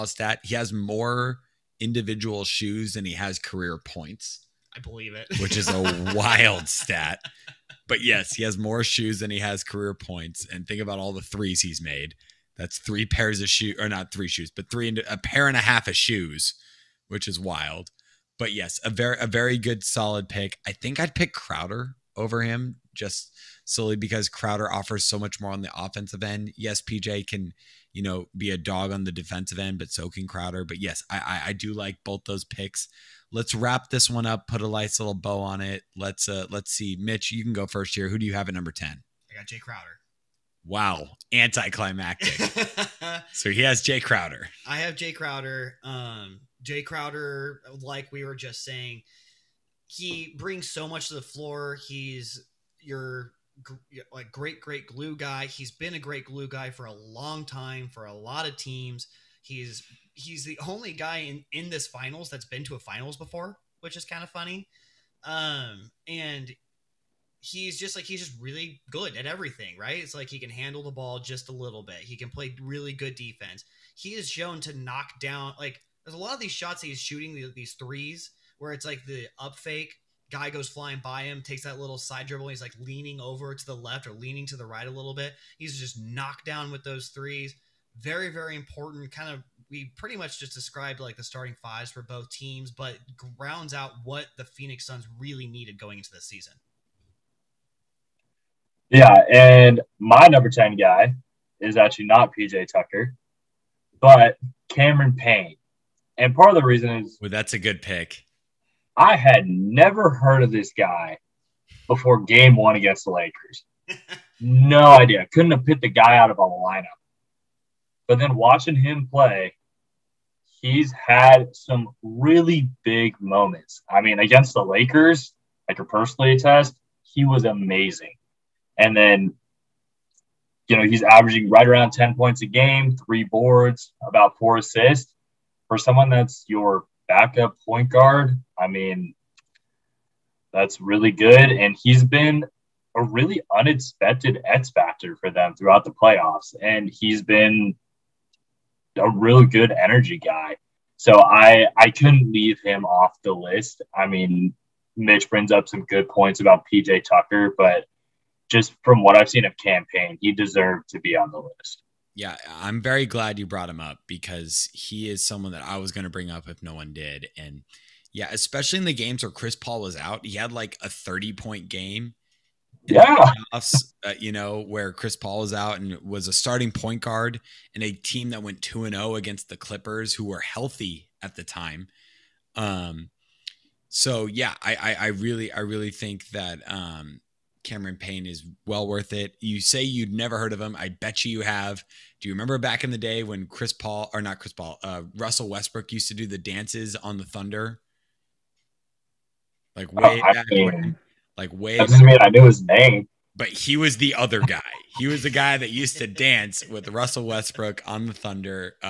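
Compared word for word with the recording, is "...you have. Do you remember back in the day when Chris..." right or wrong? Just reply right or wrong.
right.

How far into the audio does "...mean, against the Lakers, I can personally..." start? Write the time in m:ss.
2:03.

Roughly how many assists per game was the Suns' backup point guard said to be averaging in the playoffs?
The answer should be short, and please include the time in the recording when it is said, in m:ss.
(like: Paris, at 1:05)
4, at 2:14.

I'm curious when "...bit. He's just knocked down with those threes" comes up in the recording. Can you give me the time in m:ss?
1:25.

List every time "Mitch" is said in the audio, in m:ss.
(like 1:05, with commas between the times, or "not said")
0:36, 2:34.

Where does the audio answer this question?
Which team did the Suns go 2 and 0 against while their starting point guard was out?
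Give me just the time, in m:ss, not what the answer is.
2:59.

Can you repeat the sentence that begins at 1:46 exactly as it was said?
And part of the reason is well, that's a good pick.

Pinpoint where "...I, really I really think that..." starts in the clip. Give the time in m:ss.
3:04.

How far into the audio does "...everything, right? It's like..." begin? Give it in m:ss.
1:09.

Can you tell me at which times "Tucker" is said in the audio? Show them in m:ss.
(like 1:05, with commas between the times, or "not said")
1:42, 2:37.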